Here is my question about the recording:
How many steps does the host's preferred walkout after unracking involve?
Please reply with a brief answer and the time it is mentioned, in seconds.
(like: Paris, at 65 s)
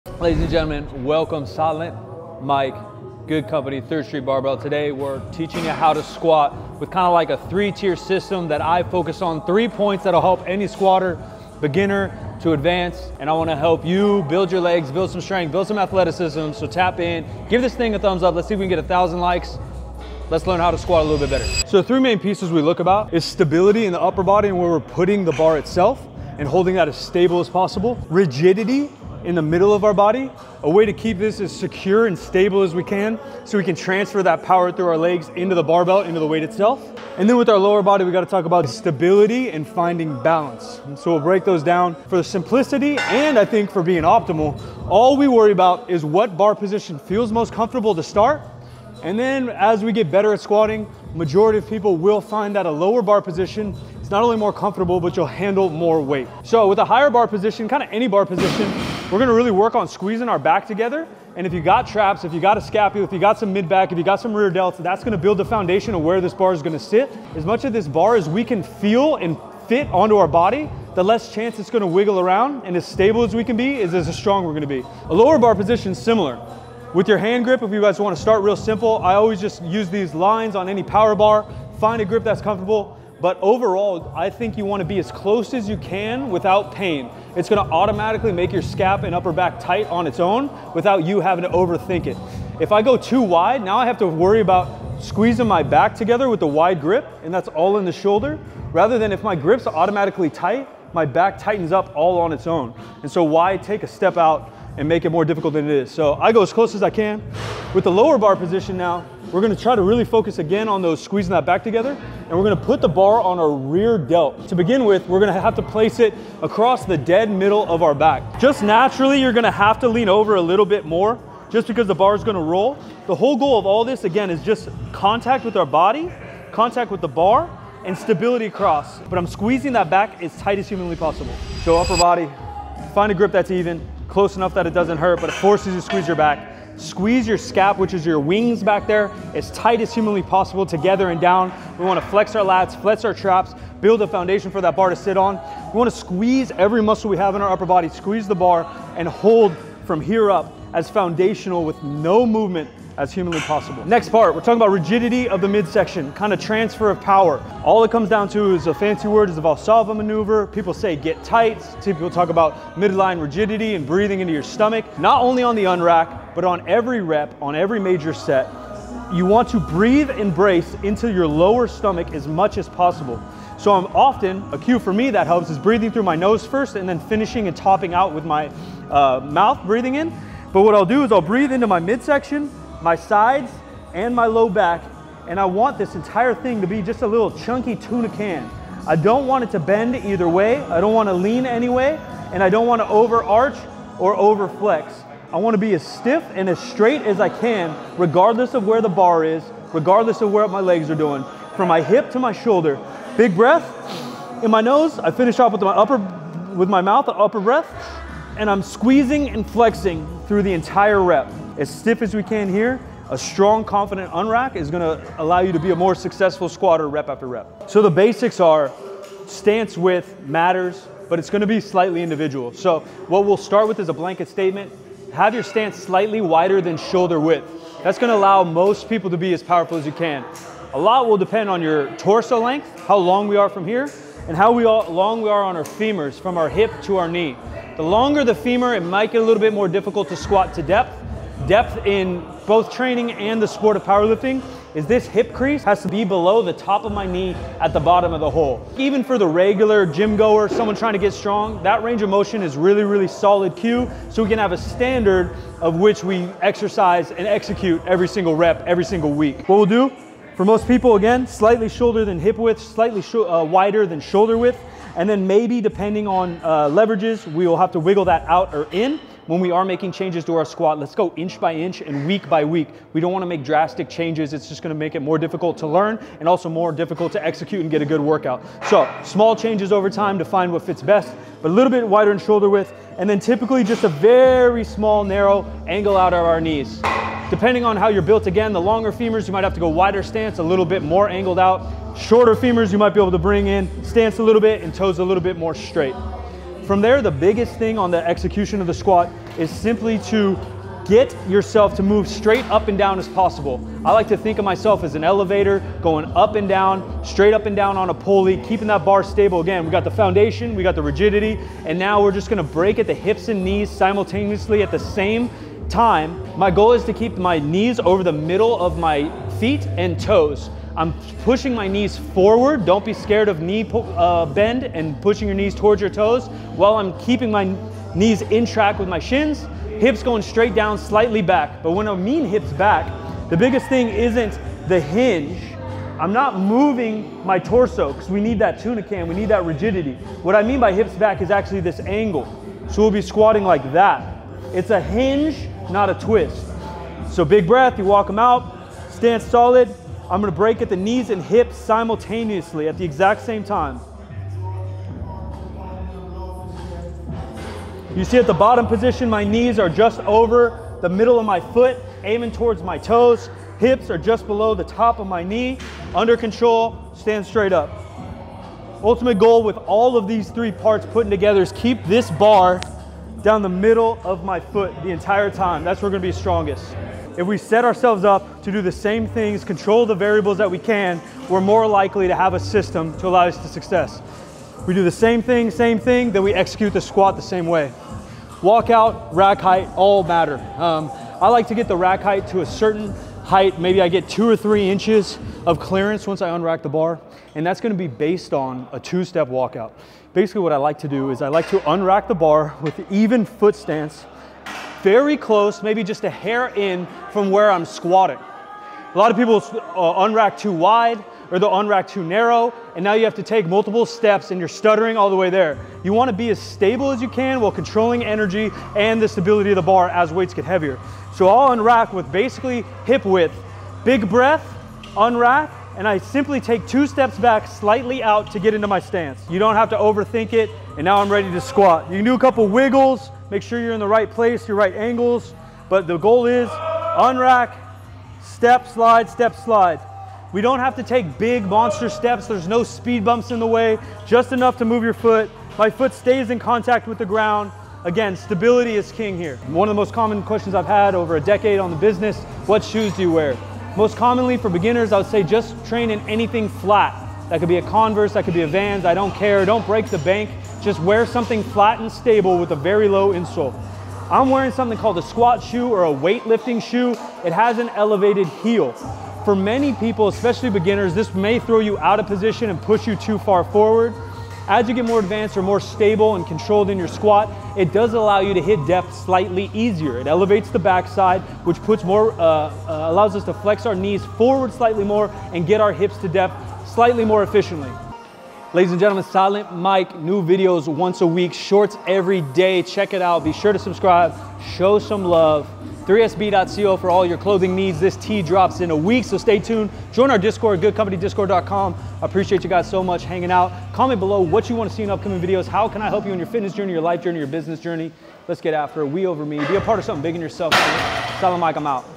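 2, at 398 s.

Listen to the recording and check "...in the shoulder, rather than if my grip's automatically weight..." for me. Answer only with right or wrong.
wrong.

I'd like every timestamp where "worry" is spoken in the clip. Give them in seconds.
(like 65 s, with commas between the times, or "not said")
45 s, 94 s.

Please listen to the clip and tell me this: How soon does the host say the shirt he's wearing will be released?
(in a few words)
in a week.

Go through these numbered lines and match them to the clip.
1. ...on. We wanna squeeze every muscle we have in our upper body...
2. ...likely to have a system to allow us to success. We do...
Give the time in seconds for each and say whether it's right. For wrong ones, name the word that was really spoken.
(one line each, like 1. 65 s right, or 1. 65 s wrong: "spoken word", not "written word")
1. 145 s right
2. 381 s right.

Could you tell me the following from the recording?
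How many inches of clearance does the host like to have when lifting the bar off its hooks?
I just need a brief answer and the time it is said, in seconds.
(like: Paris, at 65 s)
2 or 3, at 394 s.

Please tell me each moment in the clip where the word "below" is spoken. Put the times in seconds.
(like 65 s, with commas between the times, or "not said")
246 s, 364 s, 503 s.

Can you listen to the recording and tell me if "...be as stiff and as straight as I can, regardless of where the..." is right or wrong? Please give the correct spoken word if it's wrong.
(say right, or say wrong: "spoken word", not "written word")
right.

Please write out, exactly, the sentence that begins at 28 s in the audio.
Rigidity in the middle of our body.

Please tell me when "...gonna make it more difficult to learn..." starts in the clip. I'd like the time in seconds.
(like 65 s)
274 s.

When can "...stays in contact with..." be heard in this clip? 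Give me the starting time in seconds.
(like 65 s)
445 s.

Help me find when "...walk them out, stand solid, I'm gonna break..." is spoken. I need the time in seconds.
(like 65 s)
347 s.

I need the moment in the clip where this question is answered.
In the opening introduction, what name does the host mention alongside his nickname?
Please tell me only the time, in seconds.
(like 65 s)
3 s.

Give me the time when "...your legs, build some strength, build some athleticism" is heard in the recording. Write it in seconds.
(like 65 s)
14 s.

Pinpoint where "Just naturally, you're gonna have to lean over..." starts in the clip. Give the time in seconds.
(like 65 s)
118 s.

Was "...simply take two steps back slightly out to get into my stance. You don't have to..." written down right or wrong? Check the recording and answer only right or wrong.
right.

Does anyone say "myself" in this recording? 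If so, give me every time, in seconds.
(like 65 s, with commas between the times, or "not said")
304 s.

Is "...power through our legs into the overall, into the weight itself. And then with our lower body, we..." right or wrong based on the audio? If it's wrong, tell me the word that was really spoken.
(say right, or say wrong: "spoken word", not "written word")
wrong: "barbell", not "overall".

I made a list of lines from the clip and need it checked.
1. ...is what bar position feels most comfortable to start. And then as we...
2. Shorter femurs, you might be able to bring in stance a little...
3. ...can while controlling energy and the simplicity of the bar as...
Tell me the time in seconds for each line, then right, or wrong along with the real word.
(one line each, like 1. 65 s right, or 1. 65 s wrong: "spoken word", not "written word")
1. 45 s right
2. 291 s right
3. 417 s wrong: "stability", not "simplicity".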